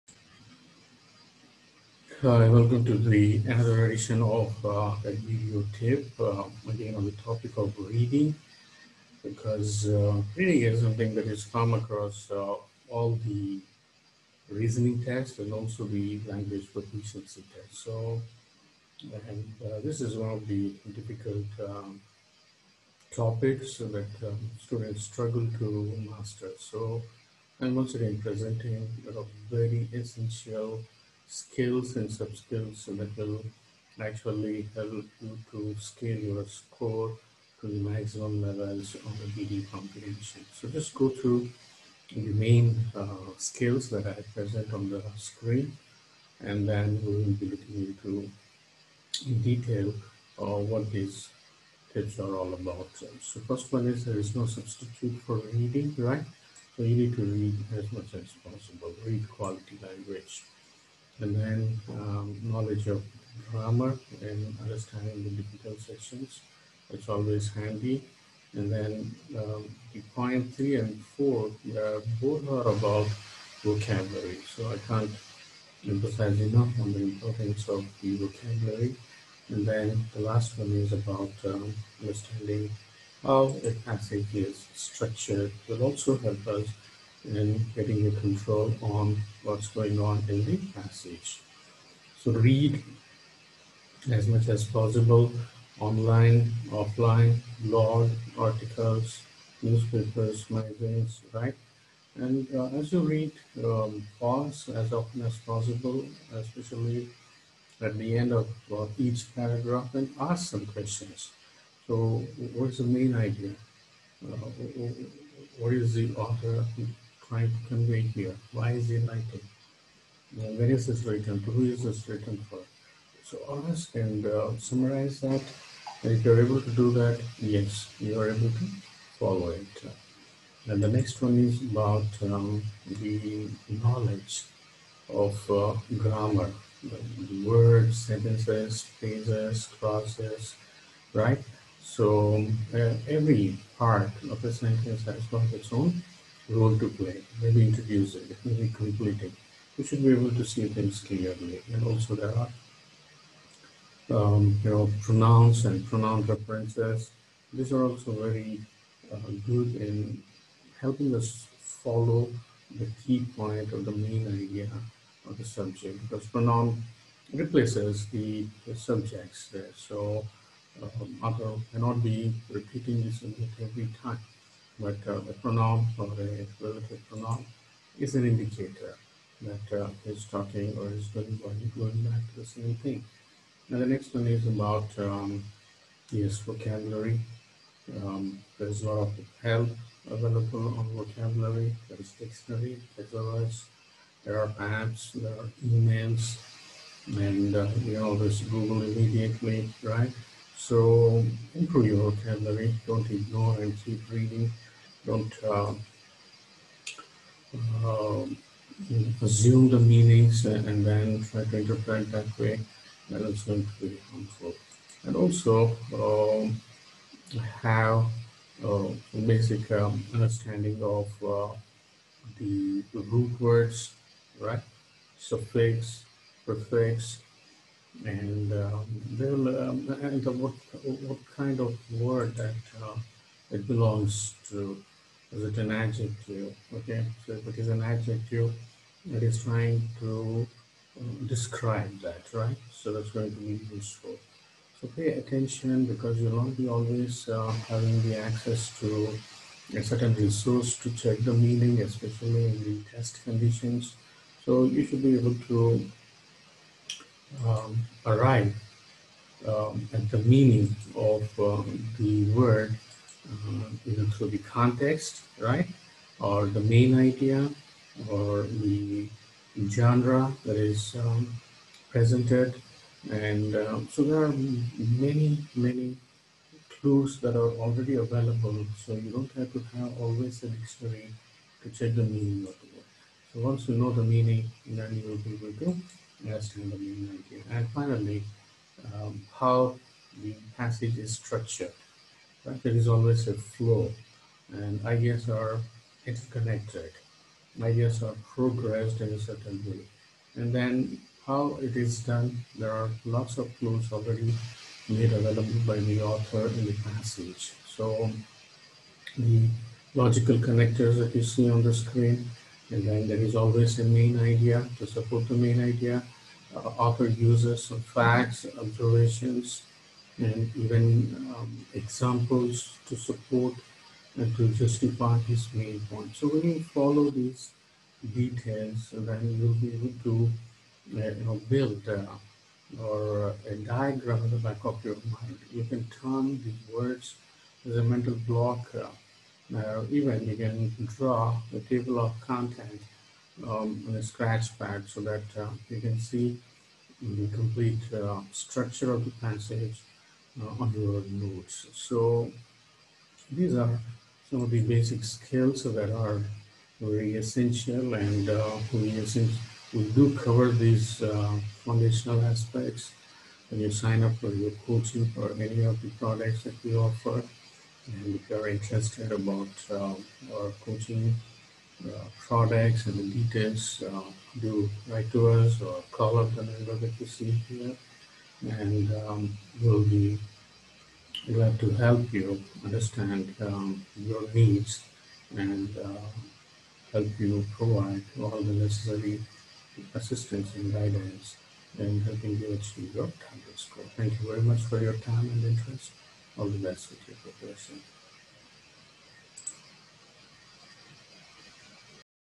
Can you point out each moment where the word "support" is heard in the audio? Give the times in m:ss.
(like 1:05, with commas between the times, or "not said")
5:14, 5:22.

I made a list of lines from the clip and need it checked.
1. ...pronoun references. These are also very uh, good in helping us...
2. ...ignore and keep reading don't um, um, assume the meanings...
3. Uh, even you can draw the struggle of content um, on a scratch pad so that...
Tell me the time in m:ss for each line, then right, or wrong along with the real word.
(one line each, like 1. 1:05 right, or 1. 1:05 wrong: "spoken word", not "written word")
1. 2:35 right
2. 3:23 right
3. 5:38 wrong: "table", not "struggle".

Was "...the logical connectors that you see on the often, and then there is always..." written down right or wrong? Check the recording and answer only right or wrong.
wrong.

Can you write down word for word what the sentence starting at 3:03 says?
Now the next one is about um, yes vocabulary.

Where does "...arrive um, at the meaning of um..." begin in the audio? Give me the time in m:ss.
4:18.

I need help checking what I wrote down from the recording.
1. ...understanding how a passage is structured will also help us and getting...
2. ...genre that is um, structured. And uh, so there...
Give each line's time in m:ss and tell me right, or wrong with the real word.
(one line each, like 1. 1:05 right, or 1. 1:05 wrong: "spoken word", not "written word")
1. 1:22 right
2. 4:29 wrong: "presented", not "structured".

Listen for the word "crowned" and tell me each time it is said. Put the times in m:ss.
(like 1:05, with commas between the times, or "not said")
not said.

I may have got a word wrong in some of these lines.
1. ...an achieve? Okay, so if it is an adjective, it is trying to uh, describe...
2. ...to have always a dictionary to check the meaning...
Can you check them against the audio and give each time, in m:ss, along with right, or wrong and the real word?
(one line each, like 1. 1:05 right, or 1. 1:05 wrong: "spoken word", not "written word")
1. 3:55 wrong: "adjective", not "achieve"
2. 4:39 right.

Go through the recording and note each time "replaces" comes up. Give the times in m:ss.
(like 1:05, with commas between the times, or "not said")
2:47.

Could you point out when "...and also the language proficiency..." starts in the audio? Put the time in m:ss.
0:15.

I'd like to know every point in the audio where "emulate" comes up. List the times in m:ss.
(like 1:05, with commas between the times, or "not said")
not said.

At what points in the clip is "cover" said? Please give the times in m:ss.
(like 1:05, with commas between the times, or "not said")
6:00.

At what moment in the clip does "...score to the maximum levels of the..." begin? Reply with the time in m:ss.
0:36.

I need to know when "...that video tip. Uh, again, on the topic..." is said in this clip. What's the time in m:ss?
0:05.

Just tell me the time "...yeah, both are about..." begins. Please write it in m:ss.
1:11.